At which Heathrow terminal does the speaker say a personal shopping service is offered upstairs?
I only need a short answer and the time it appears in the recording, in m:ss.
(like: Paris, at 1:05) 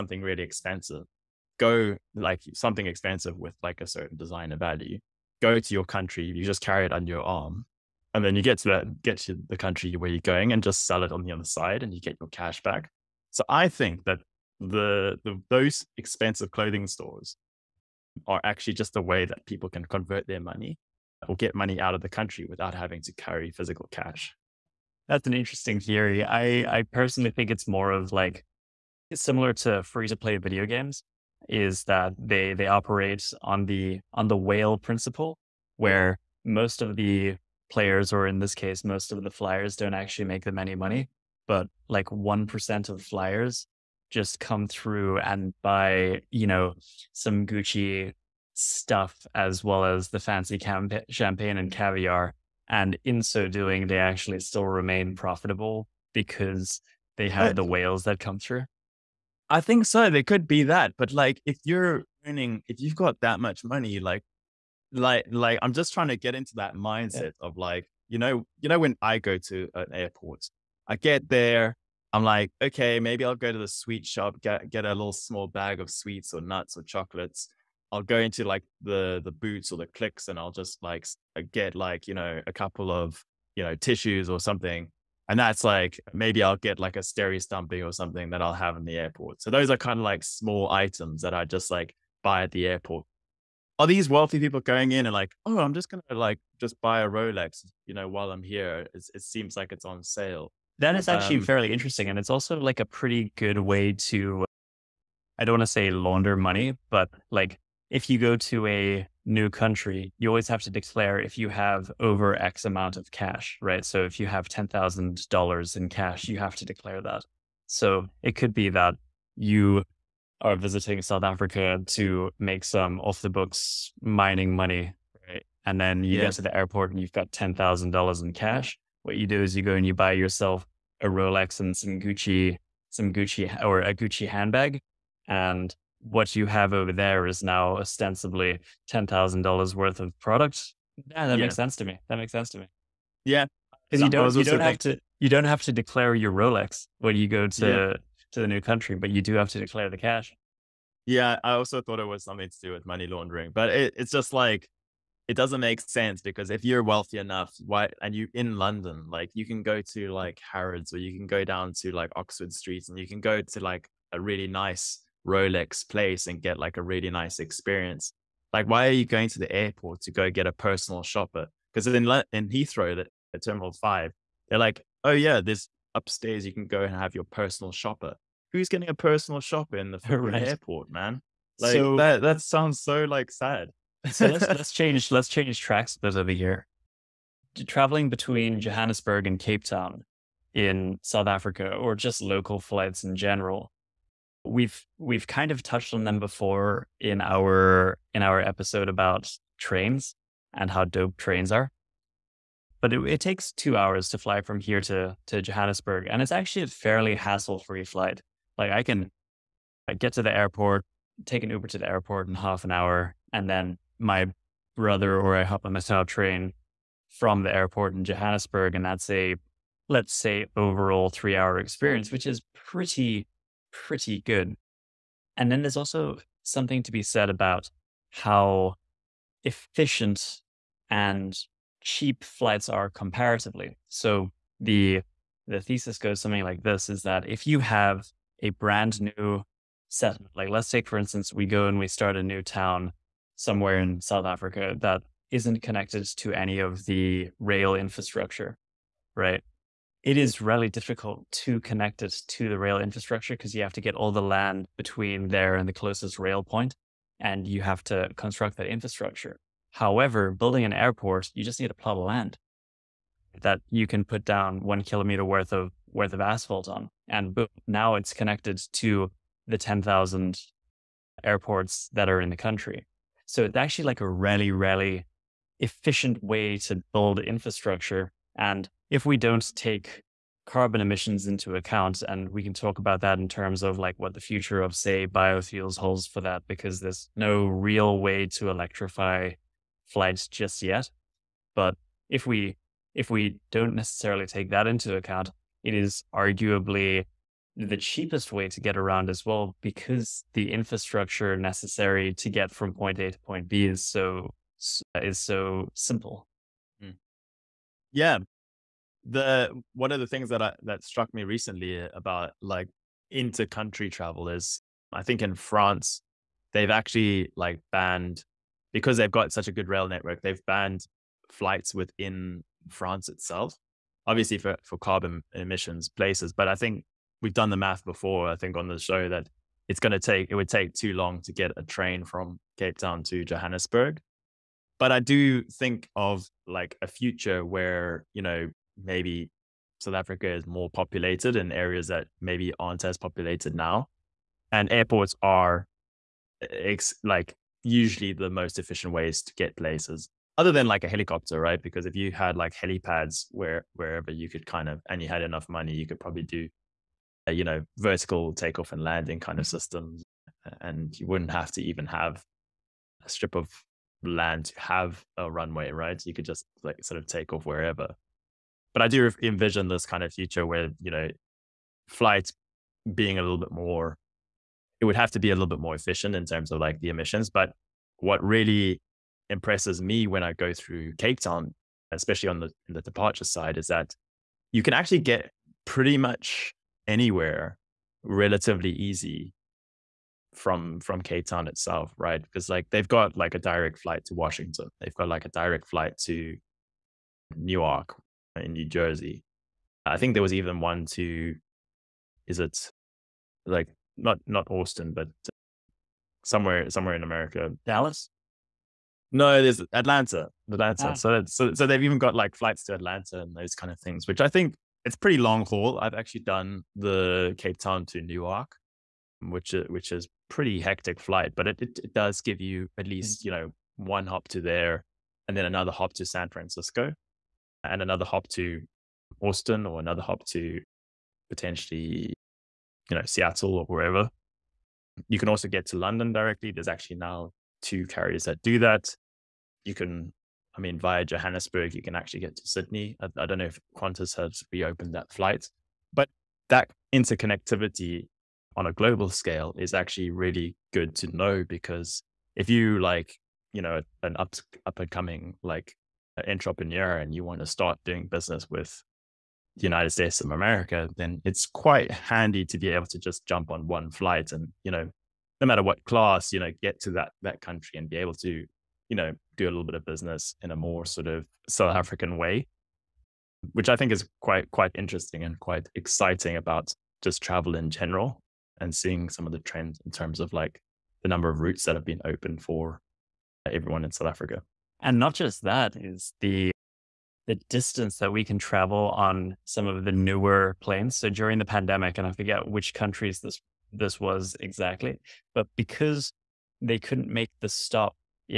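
Terminal Five, at 2:53.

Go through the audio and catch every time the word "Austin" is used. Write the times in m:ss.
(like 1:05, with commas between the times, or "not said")
6:44, 7:09.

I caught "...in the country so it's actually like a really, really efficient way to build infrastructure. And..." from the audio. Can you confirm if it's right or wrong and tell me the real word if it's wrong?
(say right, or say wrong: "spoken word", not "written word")
right.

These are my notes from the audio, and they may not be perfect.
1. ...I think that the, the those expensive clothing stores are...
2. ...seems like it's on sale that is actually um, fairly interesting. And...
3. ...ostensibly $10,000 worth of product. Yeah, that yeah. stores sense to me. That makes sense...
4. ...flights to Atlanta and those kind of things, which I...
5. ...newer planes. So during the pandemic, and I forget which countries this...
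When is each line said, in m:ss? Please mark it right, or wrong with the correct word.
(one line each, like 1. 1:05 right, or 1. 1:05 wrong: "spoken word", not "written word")
1. 0:13 right
2. 1:39 right
3. 2:17 wrong: "makes", not "stores"
4. 6:52 right
5. 8:09 right.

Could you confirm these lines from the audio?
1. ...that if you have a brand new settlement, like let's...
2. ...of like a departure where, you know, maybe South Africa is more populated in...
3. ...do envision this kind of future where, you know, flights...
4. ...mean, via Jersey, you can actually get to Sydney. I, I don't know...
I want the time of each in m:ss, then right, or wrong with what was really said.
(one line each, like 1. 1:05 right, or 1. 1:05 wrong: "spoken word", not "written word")
1. 3:57 right
2. 5:35 wrong: "future", not "departure"
3. 6:08 right
4. 7:20 wrong: "Johannesburg", not "Jersey".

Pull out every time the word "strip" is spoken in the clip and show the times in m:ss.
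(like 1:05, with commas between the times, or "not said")
6:03.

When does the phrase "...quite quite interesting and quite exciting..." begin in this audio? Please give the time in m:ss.
7:54.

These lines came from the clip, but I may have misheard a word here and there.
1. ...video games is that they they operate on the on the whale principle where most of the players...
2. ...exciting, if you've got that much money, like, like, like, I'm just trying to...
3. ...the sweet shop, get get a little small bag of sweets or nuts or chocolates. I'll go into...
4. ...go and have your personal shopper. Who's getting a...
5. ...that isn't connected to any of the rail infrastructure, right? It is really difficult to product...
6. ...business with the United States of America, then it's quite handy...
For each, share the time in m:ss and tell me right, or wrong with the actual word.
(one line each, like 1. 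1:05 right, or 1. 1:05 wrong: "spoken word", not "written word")
1. 0:30 right
2. 1:02 wrong: "earning", not "exciting"
3. 1:13 right
4. 2:56 right
5. 4:04 wrong: "connect", not "product"
6. 7:38 right.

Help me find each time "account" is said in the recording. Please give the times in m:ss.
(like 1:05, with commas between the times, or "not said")
4:41, 4:54.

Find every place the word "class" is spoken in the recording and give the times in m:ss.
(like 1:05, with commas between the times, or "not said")
7:45.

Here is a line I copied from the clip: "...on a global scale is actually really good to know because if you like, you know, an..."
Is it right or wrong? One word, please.
right.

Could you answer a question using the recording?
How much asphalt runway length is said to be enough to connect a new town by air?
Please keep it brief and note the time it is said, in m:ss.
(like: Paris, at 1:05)
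1 kilometer, at 4:24.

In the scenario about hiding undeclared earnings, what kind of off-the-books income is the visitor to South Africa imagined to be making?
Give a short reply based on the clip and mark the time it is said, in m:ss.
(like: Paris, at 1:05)
Mining money, at 2:03.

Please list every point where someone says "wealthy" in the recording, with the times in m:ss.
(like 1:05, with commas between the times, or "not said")
1:34, 2:36.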